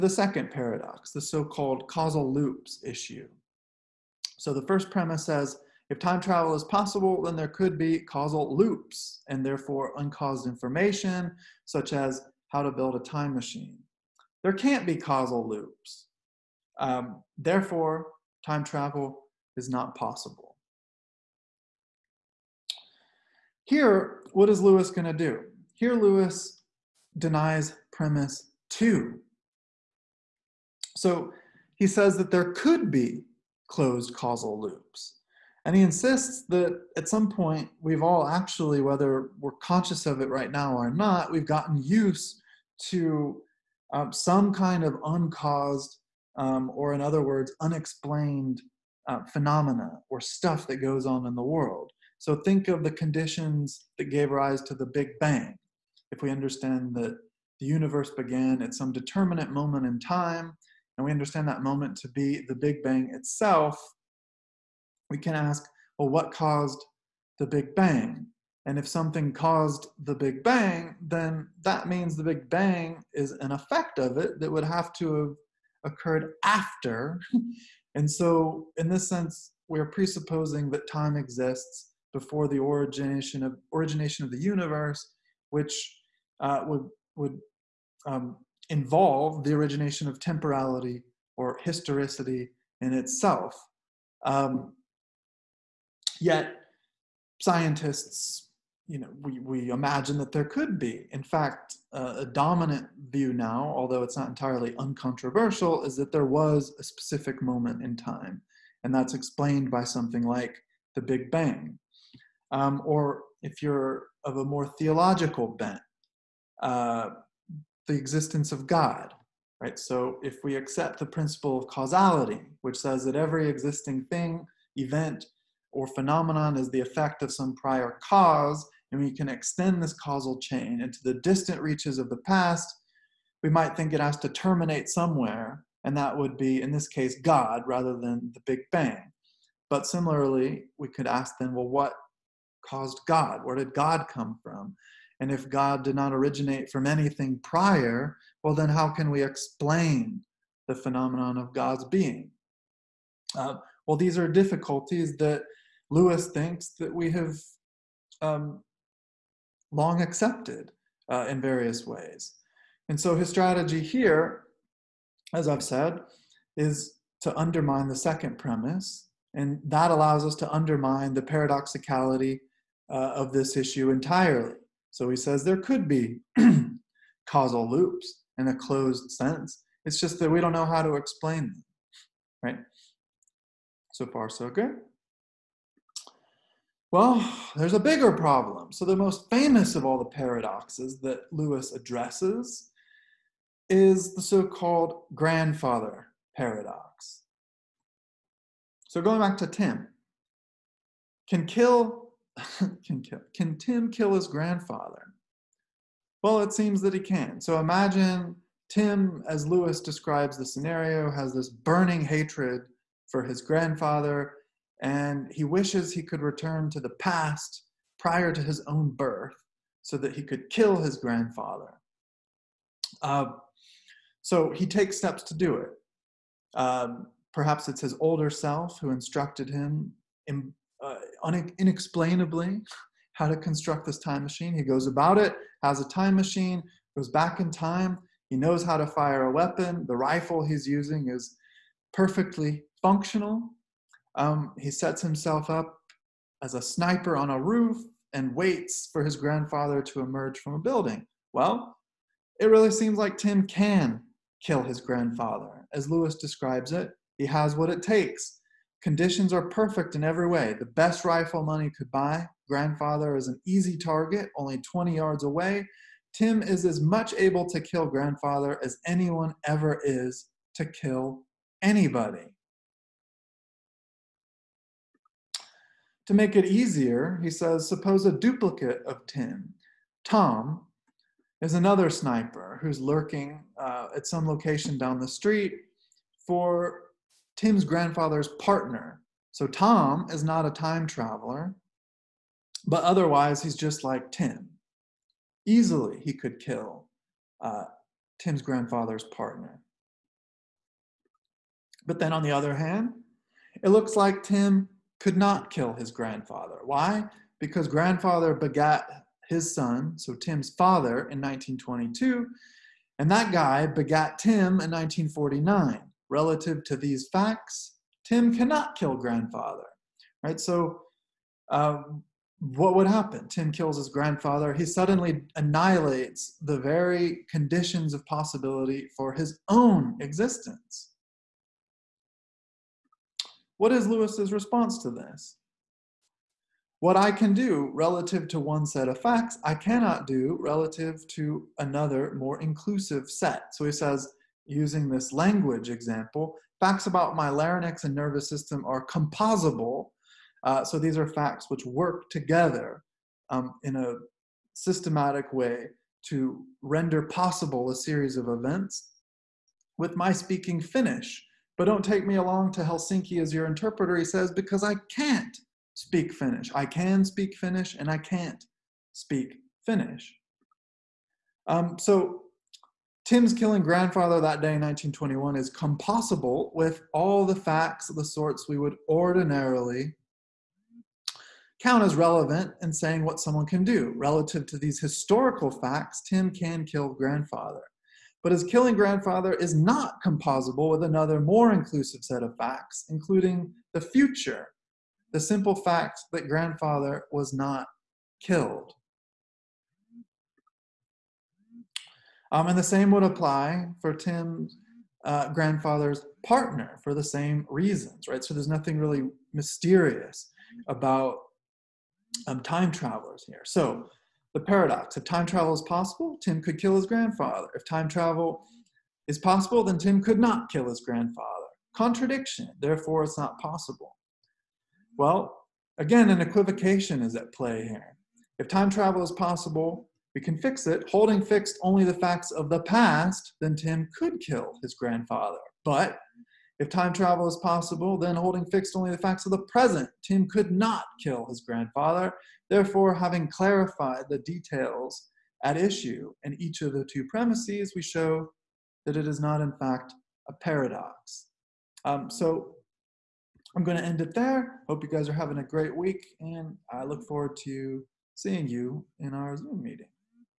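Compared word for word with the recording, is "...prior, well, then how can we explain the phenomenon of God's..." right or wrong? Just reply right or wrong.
right.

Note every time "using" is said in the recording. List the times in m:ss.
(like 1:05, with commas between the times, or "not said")
4:00, 5:44.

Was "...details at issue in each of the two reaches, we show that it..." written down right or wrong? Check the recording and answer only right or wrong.
wrong.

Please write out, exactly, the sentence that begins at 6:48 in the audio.
So there's nothing really mysterious about um, time travelers here.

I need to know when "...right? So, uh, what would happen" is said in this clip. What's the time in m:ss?
5:20.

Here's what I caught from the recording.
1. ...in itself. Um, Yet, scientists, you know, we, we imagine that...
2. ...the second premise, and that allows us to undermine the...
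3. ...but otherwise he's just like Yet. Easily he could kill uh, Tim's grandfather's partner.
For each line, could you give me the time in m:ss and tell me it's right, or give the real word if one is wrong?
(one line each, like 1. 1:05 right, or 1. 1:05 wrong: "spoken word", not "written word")
1. 1:32 right
2. 2:47 right
3. 4:52 wrong: "Tim", not "Yet".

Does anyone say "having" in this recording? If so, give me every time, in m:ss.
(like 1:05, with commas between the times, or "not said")
7:22, 7:35.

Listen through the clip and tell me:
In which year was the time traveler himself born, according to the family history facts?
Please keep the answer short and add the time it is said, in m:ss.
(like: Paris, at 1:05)
1949, at 5:14.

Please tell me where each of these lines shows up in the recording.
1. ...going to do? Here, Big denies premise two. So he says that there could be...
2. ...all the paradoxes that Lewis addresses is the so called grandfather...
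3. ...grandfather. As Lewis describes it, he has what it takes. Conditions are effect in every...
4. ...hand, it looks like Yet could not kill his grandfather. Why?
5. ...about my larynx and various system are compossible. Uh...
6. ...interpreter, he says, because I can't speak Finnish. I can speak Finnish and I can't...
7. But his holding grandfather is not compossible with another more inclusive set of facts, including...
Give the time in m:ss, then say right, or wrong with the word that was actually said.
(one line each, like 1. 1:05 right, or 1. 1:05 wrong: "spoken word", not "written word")
1. 0:24 wrong: "Lewis", not "Big"
2. 3:09 right
3. 4:14 wrong: "perfect", not "effect"
4. 5:02 wrong: "Tim", not "Yet"
5. 5:46 wrong: "nervous", not "various"
6. 6:03 right
7. 6:28 wrong: "killing", not "holding".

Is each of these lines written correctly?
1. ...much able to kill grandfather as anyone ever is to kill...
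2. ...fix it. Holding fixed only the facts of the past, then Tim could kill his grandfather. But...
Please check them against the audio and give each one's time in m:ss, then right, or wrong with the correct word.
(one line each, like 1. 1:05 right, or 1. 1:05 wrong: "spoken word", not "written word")
1. 4:26 right
2. 7:10 right.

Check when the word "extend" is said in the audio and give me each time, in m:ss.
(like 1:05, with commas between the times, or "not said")
2:09.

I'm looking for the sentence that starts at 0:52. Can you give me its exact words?
So think of the conditions that gave rise to the Big Bang.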